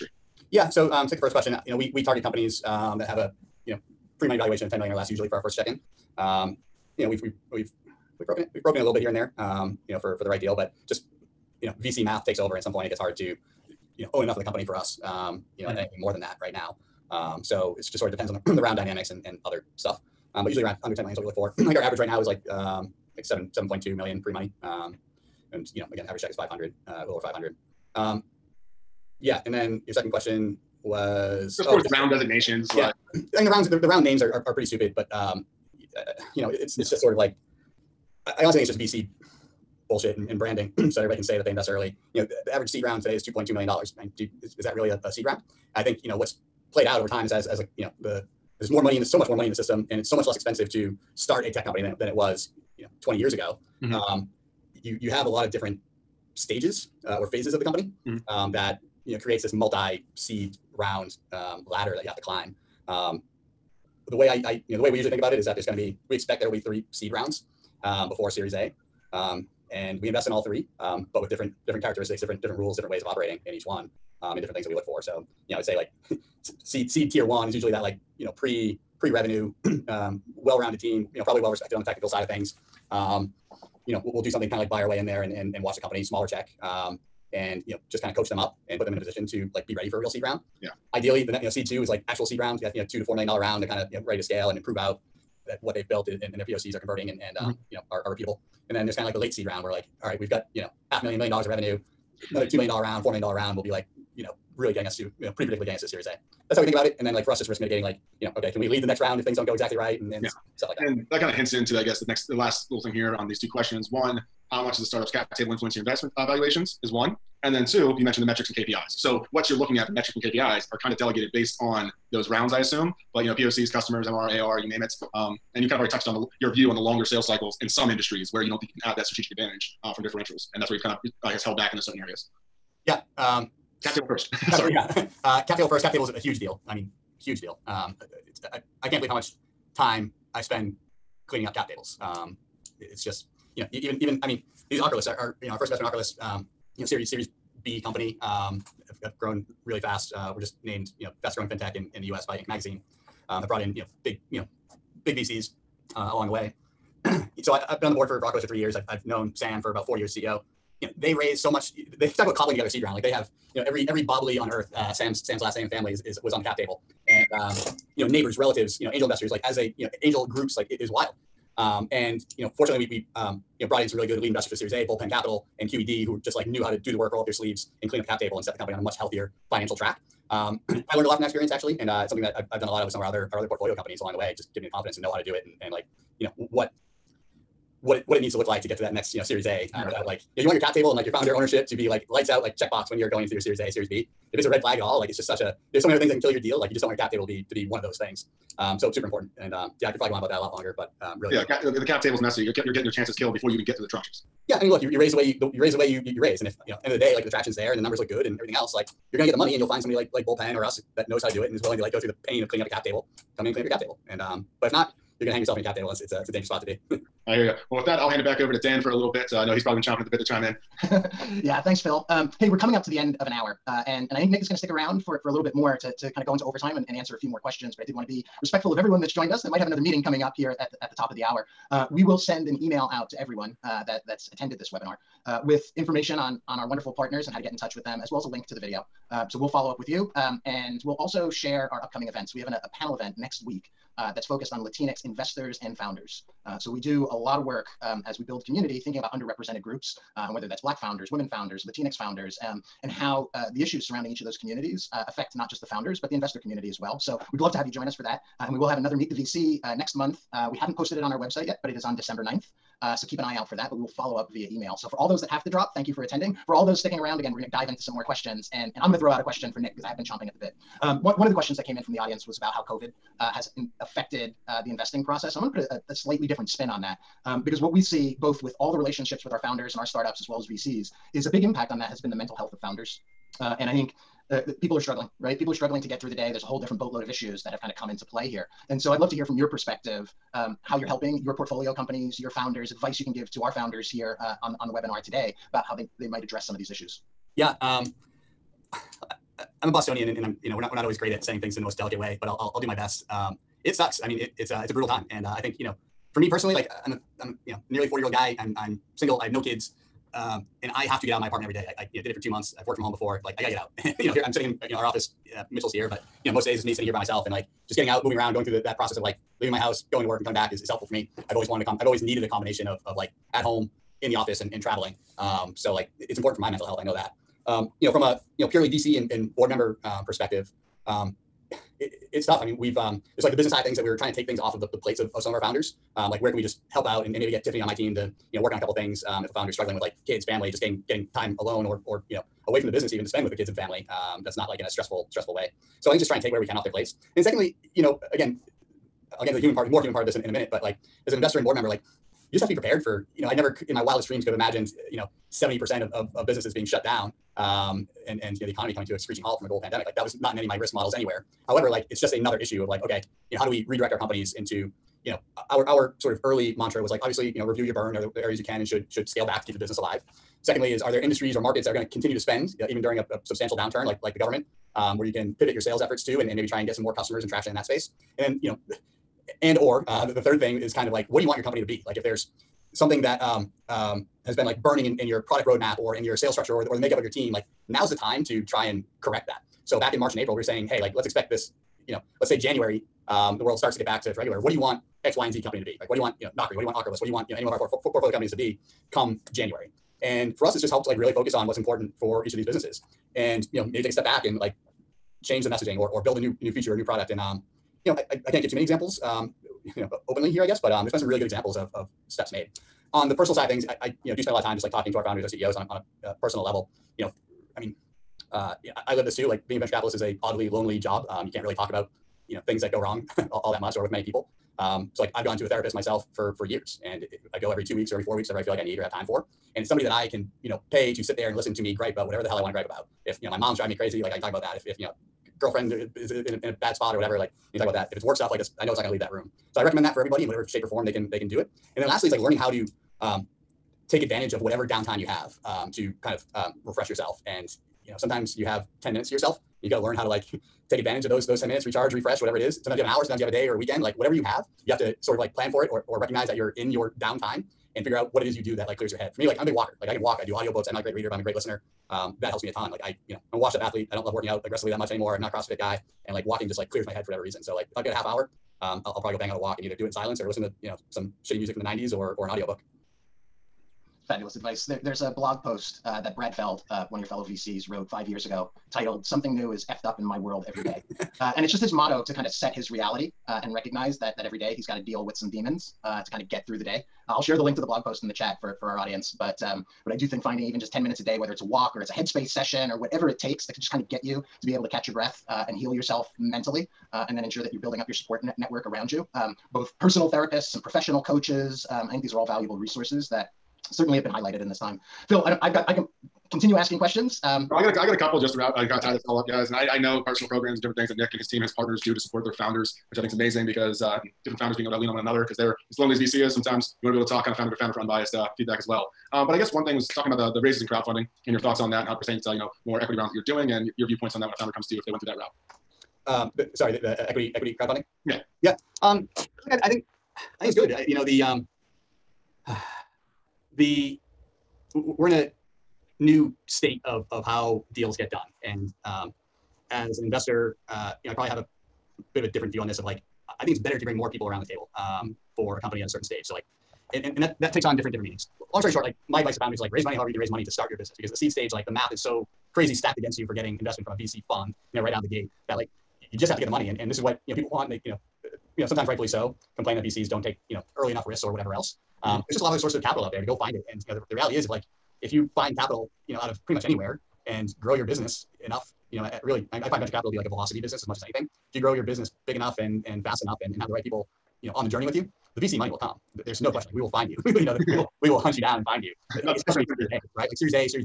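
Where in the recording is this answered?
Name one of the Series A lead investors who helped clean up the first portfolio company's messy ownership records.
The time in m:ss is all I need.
2:54.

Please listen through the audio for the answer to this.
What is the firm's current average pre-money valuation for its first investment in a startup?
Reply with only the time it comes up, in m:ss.
0:23.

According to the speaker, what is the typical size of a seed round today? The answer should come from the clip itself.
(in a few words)
$2.2 million.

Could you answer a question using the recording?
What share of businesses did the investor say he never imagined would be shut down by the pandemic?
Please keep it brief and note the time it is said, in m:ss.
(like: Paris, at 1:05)
70%, at 5:55.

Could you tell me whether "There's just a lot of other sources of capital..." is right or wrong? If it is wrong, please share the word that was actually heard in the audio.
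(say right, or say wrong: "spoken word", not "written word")
right.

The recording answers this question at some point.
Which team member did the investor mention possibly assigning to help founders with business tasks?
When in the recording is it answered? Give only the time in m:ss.
5:37.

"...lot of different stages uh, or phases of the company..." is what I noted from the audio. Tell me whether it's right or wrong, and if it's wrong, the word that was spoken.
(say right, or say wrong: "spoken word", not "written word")
right.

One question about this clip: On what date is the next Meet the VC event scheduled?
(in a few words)
December 9.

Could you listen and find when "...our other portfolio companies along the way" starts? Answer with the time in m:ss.
3:03.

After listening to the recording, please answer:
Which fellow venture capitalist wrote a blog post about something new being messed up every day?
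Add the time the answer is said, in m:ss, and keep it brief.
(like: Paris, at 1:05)
Brad Feld, at 7:56.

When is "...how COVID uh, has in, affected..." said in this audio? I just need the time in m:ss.
4:32.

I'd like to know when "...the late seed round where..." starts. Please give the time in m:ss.
1:39.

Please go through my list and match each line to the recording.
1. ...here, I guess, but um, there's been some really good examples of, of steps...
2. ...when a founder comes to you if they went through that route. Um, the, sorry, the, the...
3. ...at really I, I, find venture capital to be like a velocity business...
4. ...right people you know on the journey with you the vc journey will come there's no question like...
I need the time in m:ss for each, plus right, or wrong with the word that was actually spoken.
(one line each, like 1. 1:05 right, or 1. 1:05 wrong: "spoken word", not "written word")
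1. 6:50 right
2. 8:44 right
3. 9:29 right
4. 9:33 wrong: "money", not "journey".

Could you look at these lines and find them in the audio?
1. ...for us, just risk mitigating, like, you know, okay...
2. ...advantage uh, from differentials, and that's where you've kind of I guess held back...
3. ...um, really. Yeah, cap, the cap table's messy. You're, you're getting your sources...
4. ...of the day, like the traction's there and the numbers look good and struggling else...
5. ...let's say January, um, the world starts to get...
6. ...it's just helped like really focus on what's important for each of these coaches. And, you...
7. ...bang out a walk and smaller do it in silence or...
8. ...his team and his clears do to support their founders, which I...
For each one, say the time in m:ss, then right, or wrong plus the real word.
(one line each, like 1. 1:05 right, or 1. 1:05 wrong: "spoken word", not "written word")
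1. 1:47 right
2. 2:09 right
3. 3:21 wrong: "chances", not "sources"
4. 3:26 wrong: "everything", not "struggling"
5. 6:32 right
6. 6:40 wrong: "businesses", not "coaches"
7. 7:49 wrong: "either", not "smaller"
8. 8:31 wrong: "partners", not "clears".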